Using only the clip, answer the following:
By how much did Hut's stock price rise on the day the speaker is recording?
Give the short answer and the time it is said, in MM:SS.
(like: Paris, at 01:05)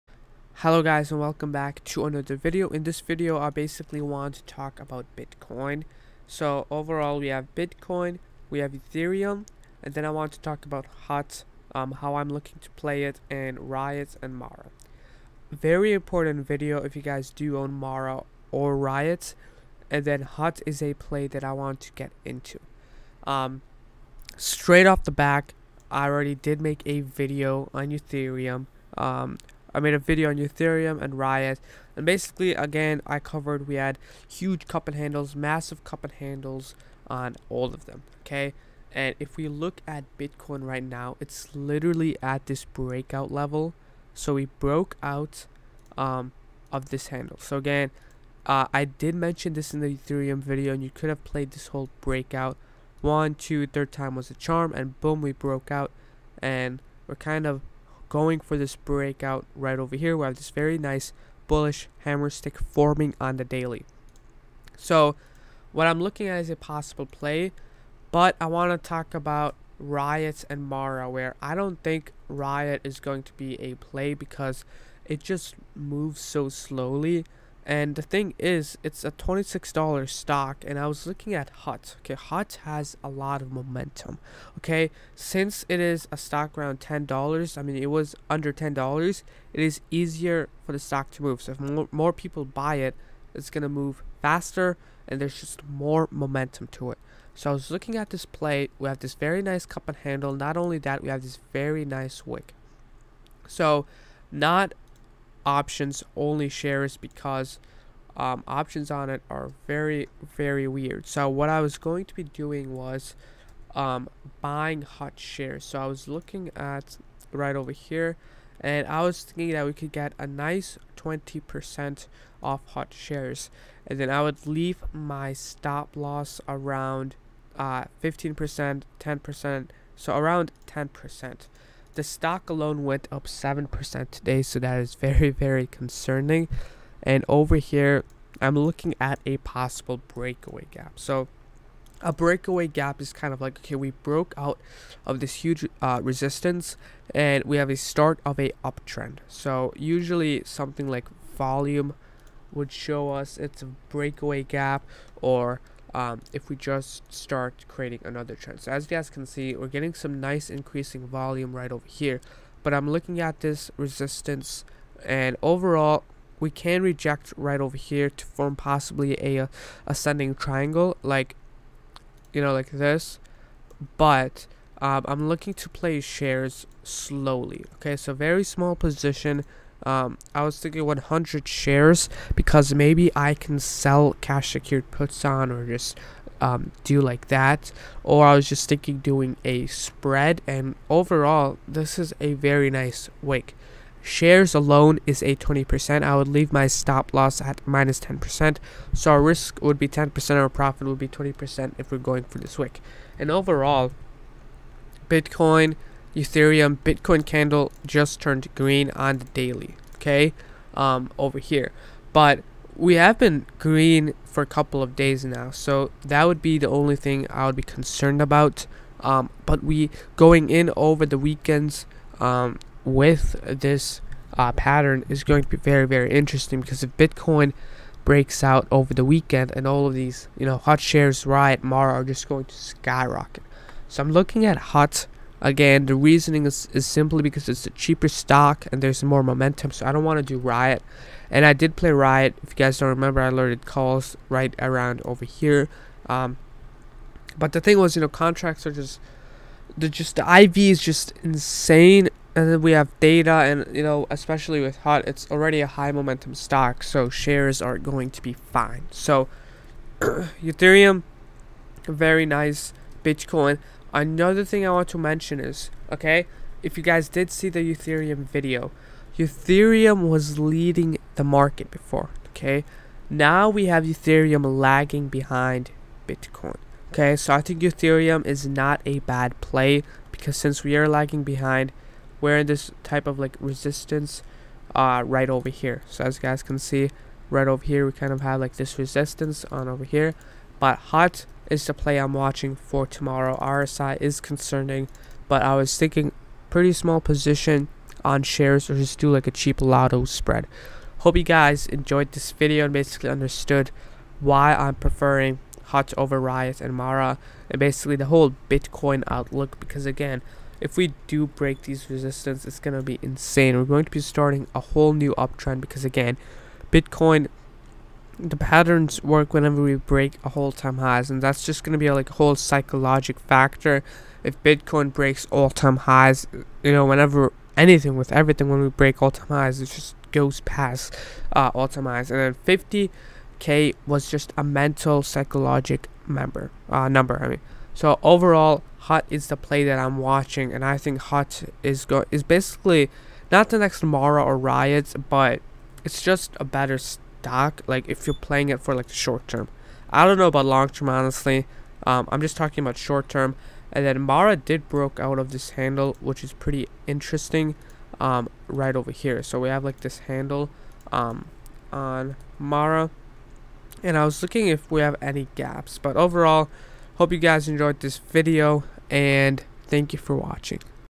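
7%, at 02:13.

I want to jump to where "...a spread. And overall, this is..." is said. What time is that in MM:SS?
03:09.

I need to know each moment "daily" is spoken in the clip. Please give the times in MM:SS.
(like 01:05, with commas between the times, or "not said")
01:03, 03:29.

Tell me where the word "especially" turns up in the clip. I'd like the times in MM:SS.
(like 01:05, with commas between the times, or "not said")
04:14.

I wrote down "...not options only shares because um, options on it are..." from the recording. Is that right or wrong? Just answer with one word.
right.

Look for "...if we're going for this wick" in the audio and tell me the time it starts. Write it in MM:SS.
03:21.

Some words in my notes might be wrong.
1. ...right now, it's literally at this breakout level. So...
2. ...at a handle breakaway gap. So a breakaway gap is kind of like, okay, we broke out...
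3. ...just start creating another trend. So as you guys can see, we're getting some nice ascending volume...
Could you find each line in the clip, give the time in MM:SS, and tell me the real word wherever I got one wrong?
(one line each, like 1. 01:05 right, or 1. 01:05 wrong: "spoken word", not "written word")
1. 00:40 right
2. 02:18 wrong: "possible", not "handle"
3. 02:36 wrong: "increasing", not "ascending".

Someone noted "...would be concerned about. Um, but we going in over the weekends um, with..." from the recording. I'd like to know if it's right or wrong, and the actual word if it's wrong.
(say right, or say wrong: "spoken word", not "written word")
right.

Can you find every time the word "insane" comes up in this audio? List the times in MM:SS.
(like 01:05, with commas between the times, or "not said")
04:11, 05:13.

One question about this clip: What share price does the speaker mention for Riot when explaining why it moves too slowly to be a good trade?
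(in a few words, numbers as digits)
$26.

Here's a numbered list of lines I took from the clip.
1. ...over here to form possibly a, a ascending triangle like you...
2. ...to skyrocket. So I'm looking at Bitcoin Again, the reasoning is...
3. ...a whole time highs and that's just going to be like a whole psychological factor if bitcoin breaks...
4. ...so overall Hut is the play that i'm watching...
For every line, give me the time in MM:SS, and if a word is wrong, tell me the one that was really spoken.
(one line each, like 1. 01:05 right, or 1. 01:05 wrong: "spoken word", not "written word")
1. 02:47 right
2. 03:52 wrong: "Hut", not "Bitcoin"
3. 05:20 right
4. 05:37 right.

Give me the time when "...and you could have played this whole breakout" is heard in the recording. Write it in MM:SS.
00:50.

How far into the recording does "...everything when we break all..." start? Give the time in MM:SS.
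05:28.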